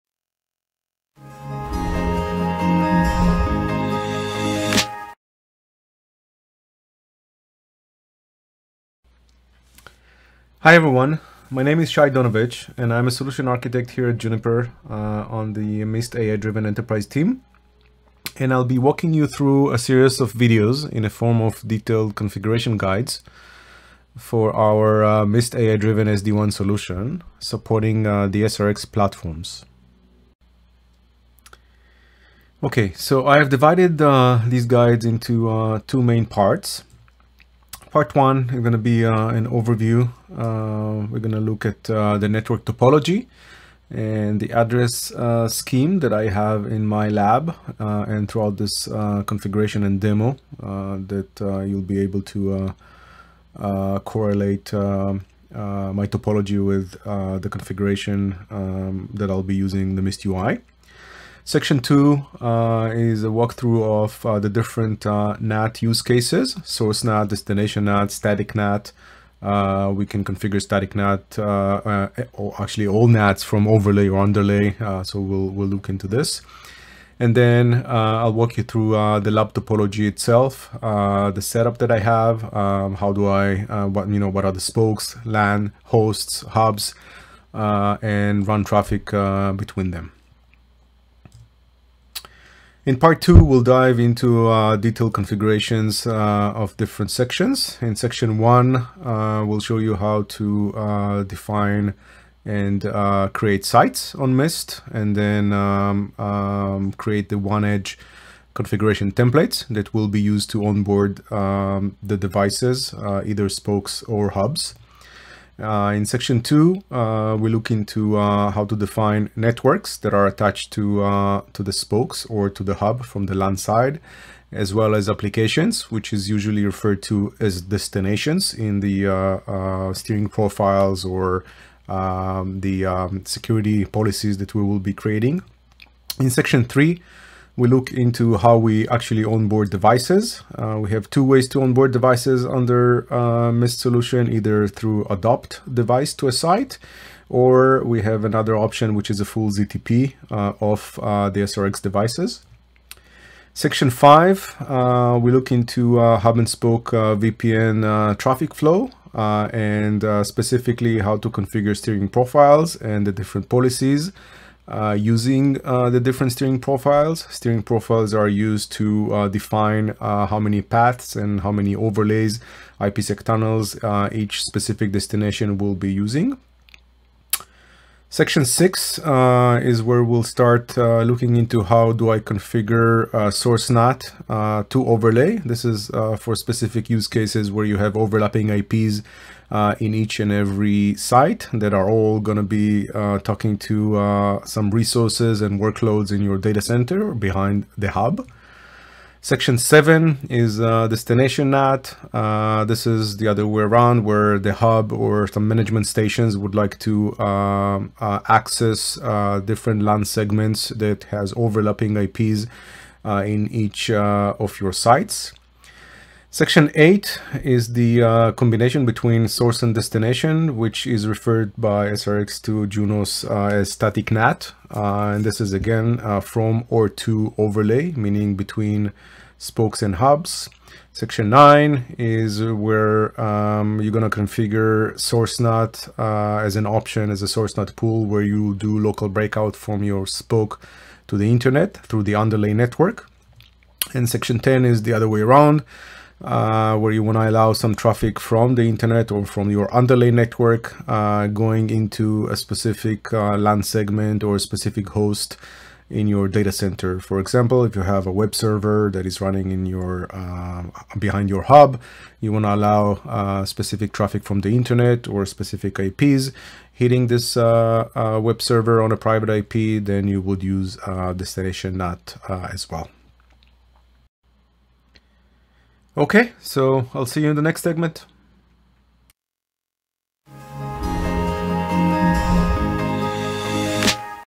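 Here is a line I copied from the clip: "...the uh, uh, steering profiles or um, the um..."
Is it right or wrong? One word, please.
right.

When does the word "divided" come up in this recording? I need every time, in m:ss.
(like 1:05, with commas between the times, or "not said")
0:33.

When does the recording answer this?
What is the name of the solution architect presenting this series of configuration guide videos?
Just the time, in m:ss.
0:11.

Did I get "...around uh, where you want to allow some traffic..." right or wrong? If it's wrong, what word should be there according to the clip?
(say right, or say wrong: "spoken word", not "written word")
right.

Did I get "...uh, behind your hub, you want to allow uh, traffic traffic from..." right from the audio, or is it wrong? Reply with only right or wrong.
wrong.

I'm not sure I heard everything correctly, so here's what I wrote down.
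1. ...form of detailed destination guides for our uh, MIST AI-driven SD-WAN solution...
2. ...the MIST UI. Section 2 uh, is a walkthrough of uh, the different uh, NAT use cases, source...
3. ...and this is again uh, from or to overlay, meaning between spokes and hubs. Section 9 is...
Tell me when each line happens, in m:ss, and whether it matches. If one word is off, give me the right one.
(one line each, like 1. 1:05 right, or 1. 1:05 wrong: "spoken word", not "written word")
1. 0:21 wrong: "configuration", not "destination"
2. 0:59 right
3. 3:45 right.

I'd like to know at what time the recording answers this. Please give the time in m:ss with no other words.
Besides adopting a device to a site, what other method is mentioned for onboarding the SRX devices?
2:29.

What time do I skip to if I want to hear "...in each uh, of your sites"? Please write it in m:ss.
3:33.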